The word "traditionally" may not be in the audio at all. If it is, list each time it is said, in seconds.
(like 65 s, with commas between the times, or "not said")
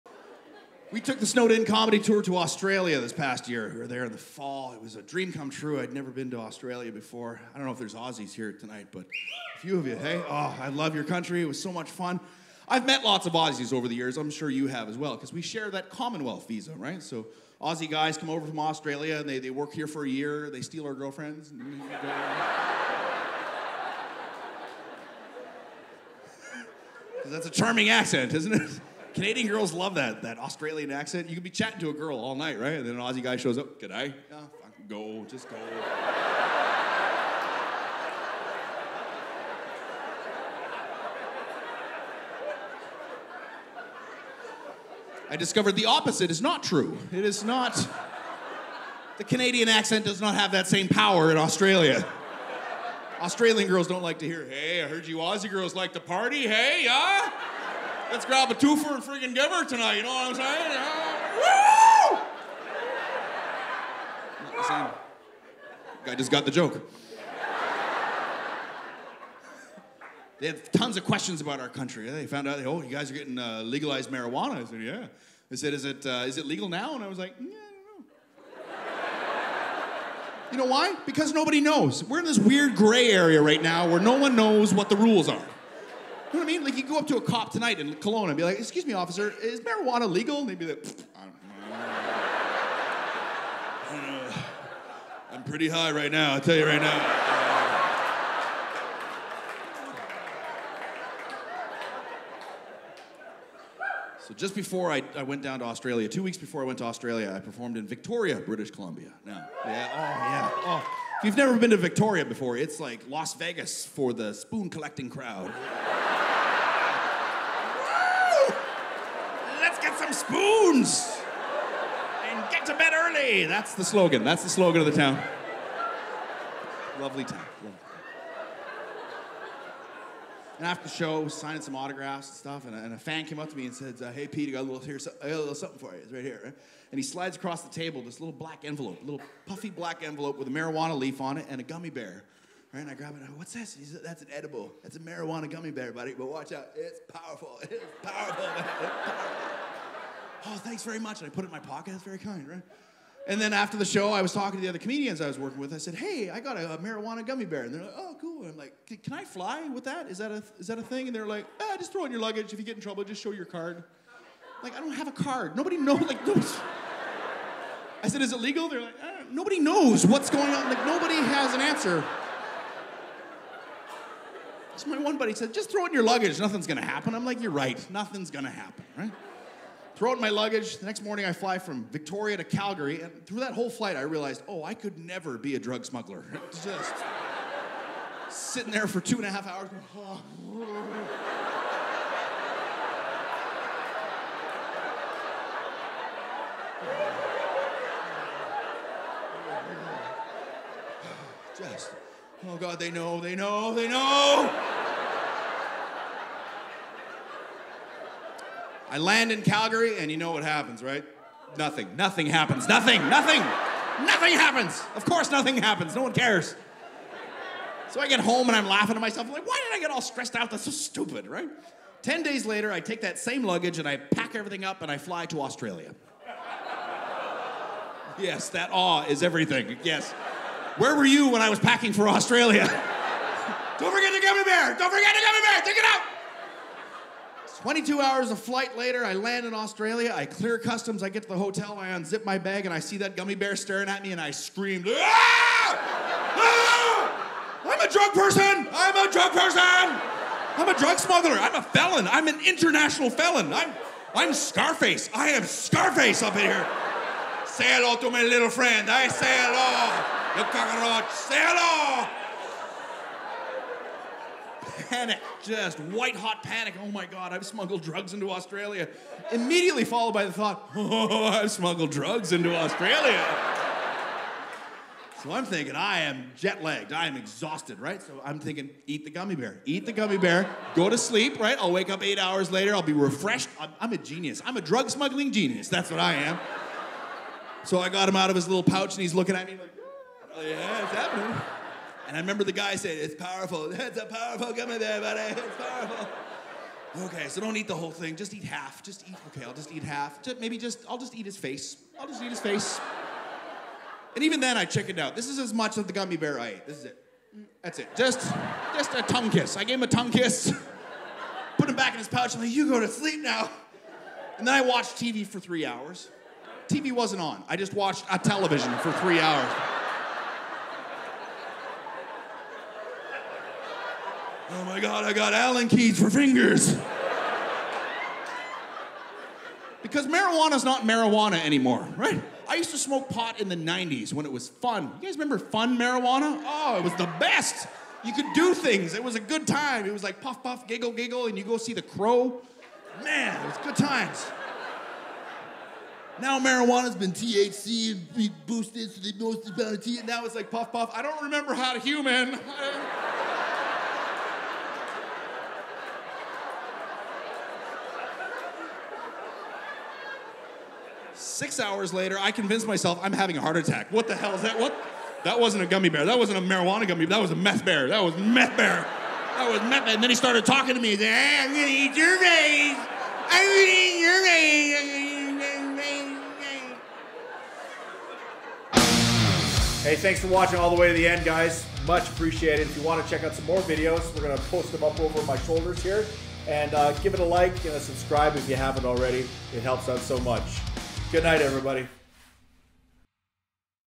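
not said.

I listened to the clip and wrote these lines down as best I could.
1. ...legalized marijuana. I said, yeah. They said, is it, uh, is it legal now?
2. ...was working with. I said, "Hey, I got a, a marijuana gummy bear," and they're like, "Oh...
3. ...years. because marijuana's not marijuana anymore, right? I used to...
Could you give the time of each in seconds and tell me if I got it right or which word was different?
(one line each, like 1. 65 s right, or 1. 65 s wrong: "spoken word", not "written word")
1. 73 s right
2. 155 s right
3. 326 s wrong: "fingers", not "years".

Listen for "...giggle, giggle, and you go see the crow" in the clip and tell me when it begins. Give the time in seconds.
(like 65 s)
340 s.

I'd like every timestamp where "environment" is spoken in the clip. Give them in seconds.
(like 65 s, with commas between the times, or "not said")
not said.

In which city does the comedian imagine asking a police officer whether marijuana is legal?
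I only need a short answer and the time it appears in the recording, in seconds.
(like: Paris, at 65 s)
Kelowna, at 87 s.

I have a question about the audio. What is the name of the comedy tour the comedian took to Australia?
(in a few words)
Snowed In.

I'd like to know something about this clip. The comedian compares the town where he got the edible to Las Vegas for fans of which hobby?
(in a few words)
spoon collecting.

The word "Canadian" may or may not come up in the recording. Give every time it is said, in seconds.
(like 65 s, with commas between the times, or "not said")
29 s, 49 s.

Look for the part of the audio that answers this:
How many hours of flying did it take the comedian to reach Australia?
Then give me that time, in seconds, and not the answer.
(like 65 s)
237 s.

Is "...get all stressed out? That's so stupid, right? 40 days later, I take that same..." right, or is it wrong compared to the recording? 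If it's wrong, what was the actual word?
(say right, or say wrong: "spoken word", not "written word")
wrong: "10", not "40".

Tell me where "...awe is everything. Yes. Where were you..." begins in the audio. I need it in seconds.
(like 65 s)
228 s.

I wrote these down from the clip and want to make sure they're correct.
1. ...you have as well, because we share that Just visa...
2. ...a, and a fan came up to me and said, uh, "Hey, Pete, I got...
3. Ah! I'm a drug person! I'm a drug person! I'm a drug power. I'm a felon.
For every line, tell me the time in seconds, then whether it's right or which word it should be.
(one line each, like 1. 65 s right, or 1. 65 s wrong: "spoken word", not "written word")
1. 14 s wrong: "Commonwealth", not "Just"
2. 132 s right
3. 246 s wrong: "smuggler", not "power".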